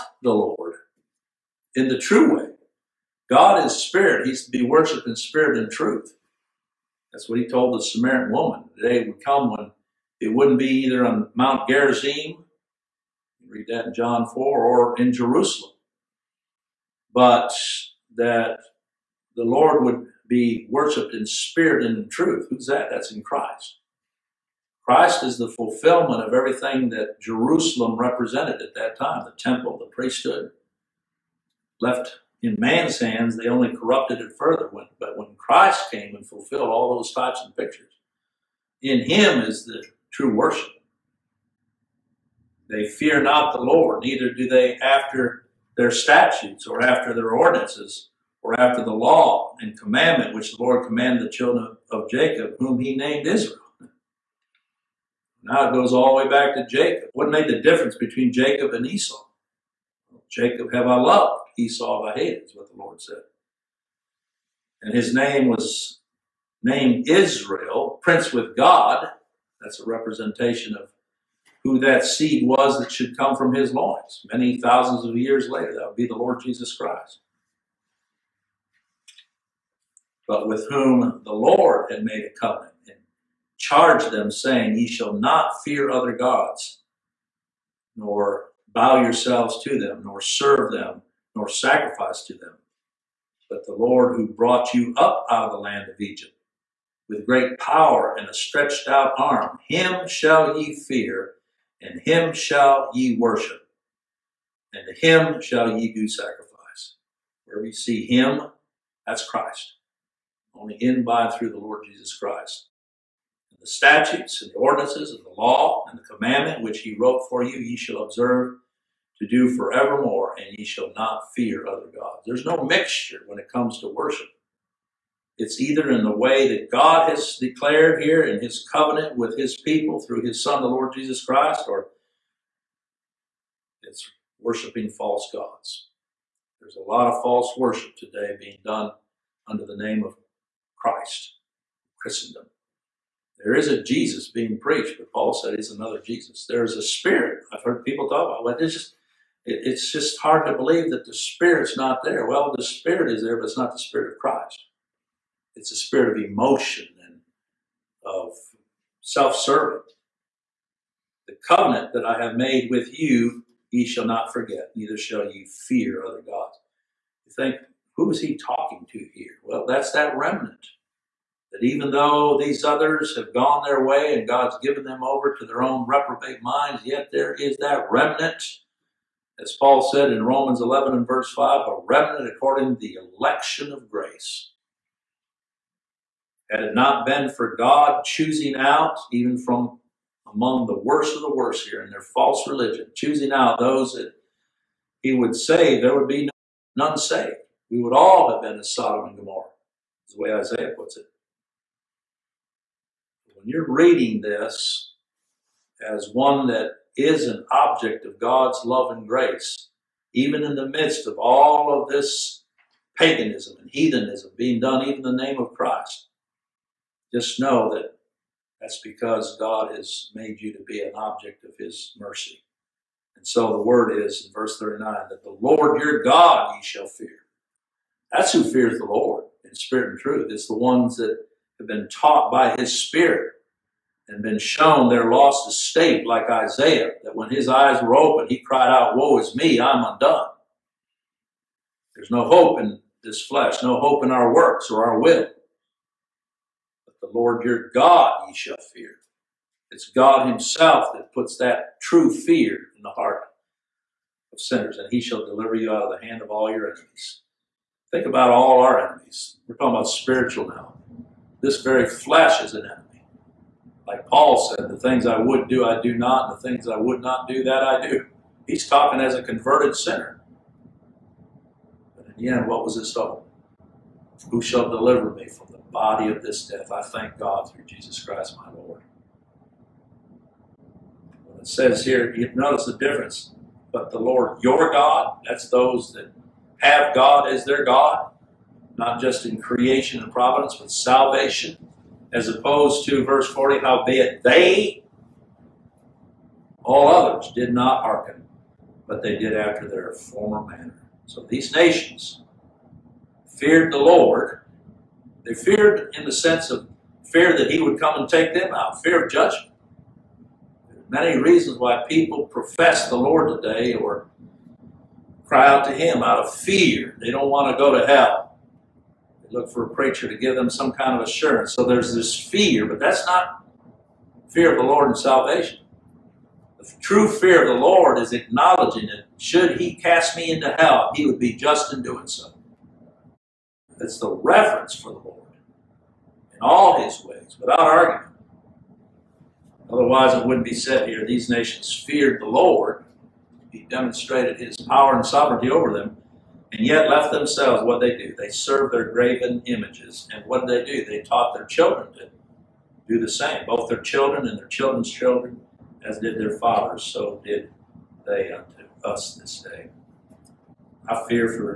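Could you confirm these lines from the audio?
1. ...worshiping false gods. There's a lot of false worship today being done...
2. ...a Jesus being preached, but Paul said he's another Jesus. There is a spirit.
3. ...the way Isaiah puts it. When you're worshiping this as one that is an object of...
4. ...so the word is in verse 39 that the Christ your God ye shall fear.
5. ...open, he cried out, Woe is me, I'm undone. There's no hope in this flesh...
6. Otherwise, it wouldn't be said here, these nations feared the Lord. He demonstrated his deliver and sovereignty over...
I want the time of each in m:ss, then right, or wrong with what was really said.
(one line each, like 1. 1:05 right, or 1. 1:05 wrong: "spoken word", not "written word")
1. 2:14 right
2. 2:23 right
3. 3:20 wrong: "reading", not "worshiping"
4. 3:43 wrong: "Lord", not "Christ"
5. 3:57 right
6. 5:39 wrong: "power", not "deliver".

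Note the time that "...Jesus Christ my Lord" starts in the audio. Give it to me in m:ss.
4:37.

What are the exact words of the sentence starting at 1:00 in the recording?
Jacob have I loved, Esau have I hated, is what the Lord said.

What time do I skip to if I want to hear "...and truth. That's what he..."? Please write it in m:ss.
0:05.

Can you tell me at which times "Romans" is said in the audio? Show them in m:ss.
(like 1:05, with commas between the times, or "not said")
3:00.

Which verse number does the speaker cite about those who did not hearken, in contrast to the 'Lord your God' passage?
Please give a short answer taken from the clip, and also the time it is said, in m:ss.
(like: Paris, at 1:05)
40, at 4:53.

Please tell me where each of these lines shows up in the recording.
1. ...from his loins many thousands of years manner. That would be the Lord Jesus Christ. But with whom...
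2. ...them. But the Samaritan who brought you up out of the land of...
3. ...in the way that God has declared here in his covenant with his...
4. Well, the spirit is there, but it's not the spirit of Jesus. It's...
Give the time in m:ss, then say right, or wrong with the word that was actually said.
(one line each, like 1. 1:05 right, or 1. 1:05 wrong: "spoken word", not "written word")
1. 1:13 wrong: "later", not "manner"
2. 1:32 wrong: "Lord", not "Samaritan"
3. 2:05 right
4. 2:32 wrong: "Christ", not "Jesus".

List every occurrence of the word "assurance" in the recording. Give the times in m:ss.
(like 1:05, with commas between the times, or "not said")
5:21.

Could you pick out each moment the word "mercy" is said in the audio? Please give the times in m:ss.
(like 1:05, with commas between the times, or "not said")
3:41.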